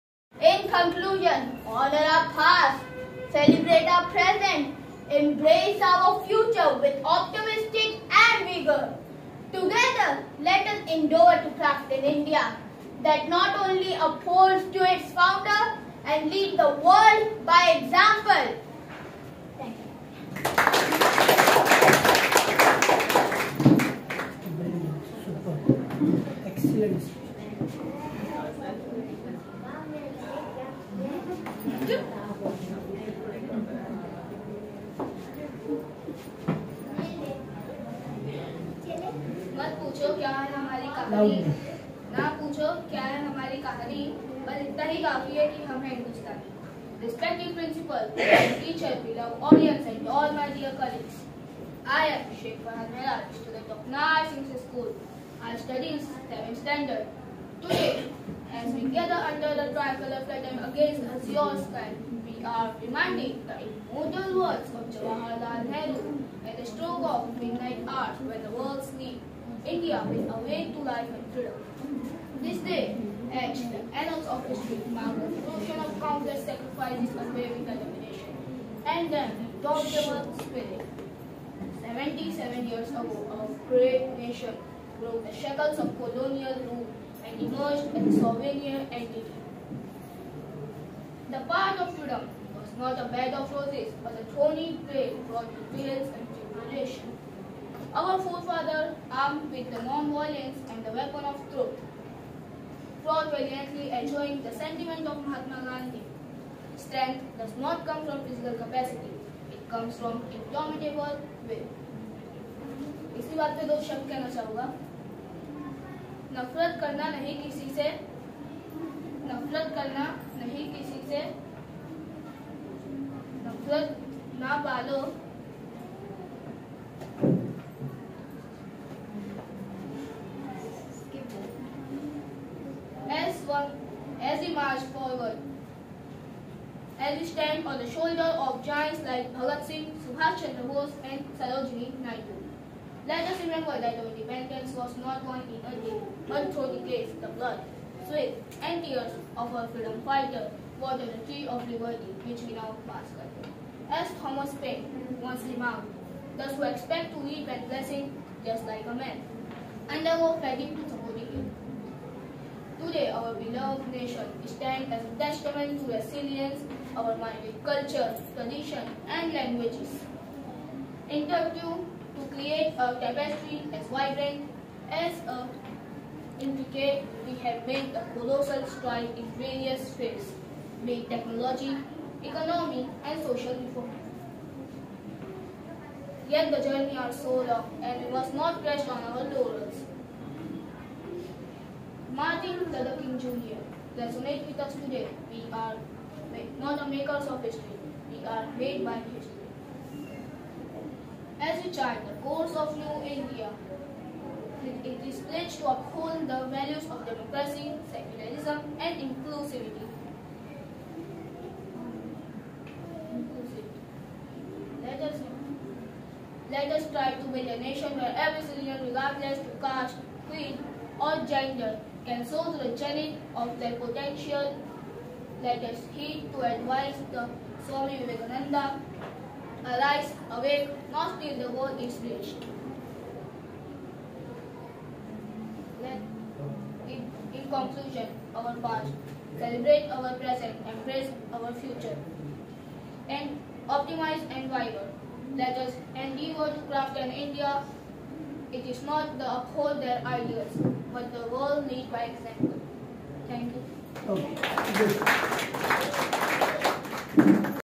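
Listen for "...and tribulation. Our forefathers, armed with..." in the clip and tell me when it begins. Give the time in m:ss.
1:36.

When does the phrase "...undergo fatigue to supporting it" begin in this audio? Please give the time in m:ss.
2:39.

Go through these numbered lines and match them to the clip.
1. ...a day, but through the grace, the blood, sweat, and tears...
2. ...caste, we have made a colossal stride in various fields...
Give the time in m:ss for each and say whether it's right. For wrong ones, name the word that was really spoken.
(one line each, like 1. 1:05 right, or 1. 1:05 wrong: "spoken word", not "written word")
1. 2:25 right
2. 2:56 wrong: "indicate", not "caste".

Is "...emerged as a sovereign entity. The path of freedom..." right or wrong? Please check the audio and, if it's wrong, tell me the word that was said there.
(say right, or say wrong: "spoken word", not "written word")
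right.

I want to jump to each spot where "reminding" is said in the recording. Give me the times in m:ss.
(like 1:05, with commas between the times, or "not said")
1:02.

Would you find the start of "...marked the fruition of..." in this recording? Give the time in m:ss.
1:14.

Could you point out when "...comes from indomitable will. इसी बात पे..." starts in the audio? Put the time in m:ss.
1:49.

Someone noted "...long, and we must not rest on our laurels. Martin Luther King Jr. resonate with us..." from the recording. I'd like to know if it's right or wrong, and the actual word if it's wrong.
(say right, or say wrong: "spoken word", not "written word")
right.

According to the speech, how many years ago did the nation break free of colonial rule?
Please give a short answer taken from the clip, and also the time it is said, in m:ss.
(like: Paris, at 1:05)
77, at 1:21.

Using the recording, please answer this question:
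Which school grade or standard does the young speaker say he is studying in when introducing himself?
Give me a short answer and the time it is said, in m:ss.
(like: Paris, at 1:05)
7th standard, at 0:56.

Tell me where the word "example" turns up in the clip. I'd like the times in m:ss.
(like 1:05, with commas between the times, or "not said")
0:17, 4:12.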